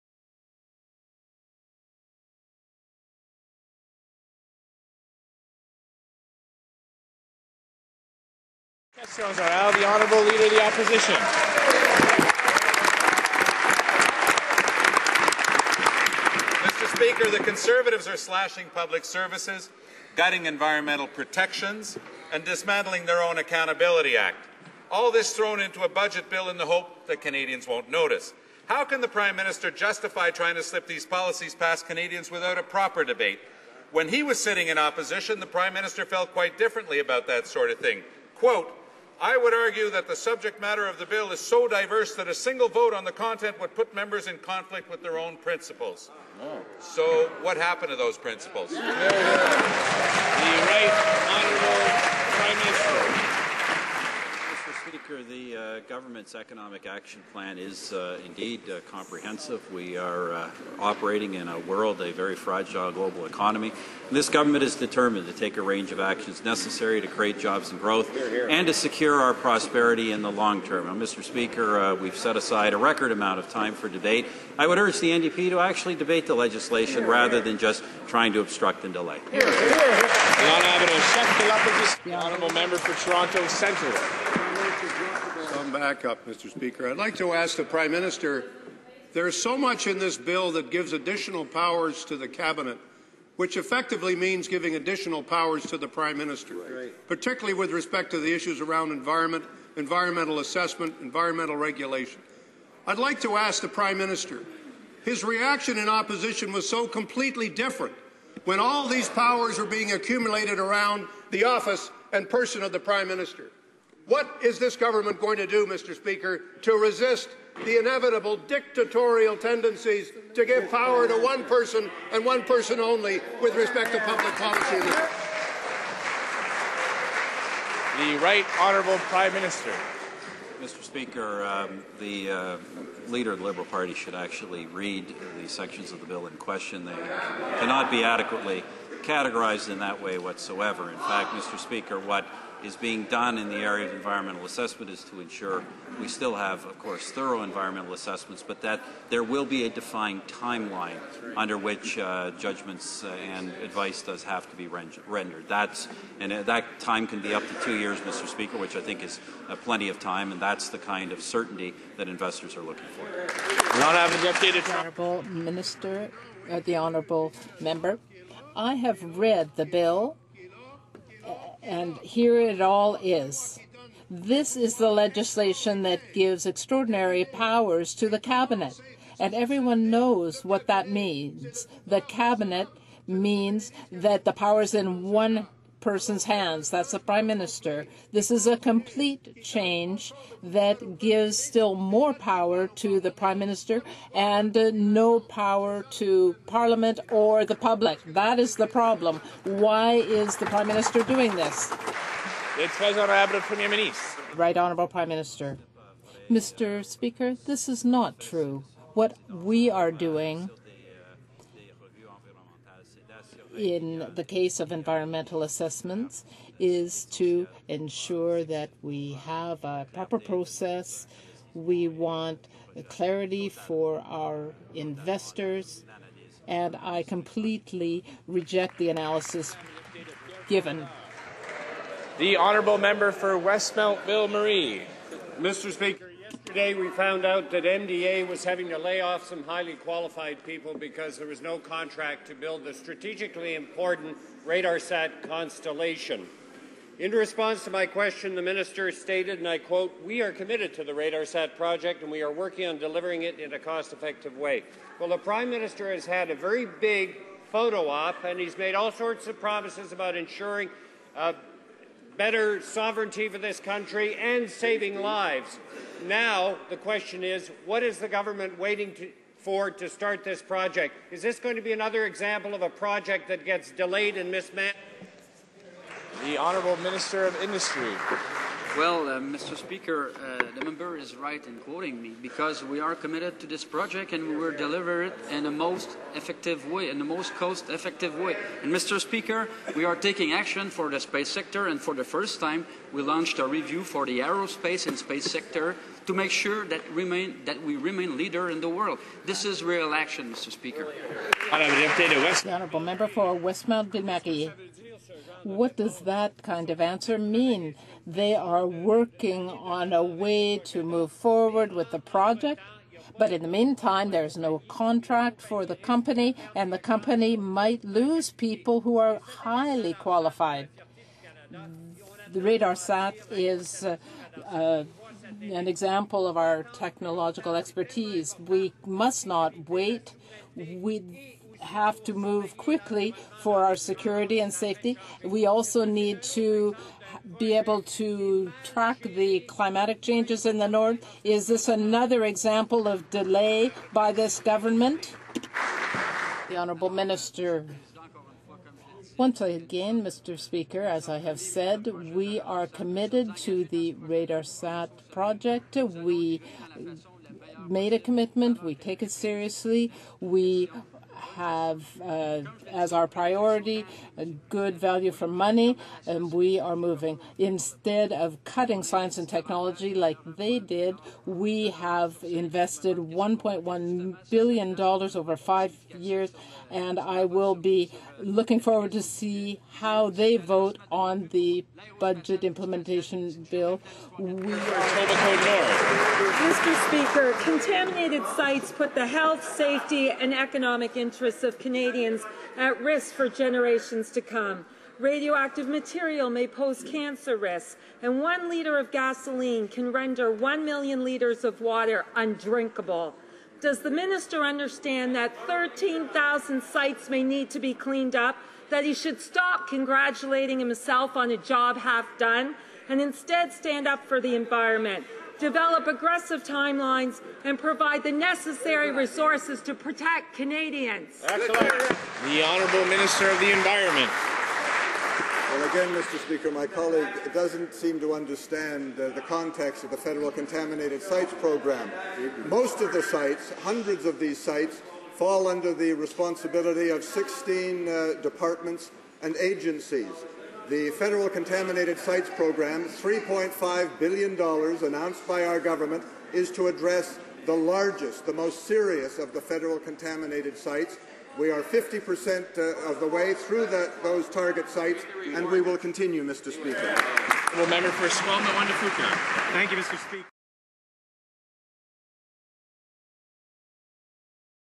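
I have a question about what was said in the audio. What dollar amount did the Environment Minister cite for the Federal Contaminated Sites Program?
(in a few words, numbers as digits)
$3.5 billion.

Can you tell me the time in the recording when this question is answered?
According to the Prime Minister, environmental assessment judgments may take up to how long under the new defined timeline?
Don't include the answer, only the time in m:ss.
2:37.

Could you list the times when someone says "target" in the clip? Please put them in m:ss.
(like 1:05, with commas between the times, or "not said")
7:34.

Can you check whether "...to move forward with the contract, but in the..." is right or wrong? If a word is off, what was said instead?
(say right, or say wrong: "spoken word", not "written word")
wrong: "project", not "contract".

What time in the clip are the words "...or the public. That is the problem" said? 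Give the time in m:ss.
3:17.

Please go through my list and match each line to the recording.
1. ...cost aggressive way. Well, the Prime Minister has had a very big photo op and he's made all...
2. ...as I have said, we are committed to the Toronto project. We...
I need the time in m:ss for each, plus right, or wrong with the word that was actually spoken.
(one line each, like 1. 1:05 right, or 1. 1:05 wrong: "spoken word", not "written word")
1. 4:13 wrong: "effective", not "aggressive"
2. 5:50 wrong: "RadarSat", not "Toronto".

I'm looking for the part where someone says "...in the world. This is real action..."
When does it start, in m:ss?
4:58.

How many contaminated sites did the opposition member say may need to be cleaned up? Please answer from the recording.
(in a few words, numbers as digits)
13,000.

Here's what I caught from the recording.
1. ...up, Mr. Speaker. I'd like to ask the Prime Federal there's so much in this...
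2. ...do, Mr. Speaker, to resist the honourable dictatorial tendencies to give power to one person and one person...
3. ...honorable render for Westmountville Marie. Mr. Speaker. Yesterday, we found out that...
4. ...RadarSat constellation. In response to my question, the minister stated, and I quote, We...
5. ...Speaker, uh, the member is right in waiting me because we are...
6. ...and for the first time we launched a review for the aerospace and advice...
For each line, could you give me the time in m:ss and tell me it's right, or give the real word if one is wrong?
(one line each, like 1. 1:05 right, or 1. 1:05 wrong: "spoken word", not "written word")
1. 1:26 wrong: "Minister", not "Federal"
2. 1:55 wrong: "inevitable", not "honourable"
3. 3:52 wrong: "member", not "render"
4. 4:04 right
5. 4:39 wrong: "quoting", not "waiting"
6. 4:51 wrong: "space", not "advice".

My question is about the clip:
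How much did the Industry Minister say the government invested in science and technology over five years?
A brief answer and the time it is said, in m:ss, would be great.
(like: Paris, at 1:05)
$1.1 billion, at 6:12.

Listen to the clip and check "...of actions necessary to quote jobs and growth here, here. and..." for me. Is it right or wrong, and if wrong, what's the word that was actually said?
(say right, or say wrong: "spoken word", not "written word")
wrong: "create", not "quote".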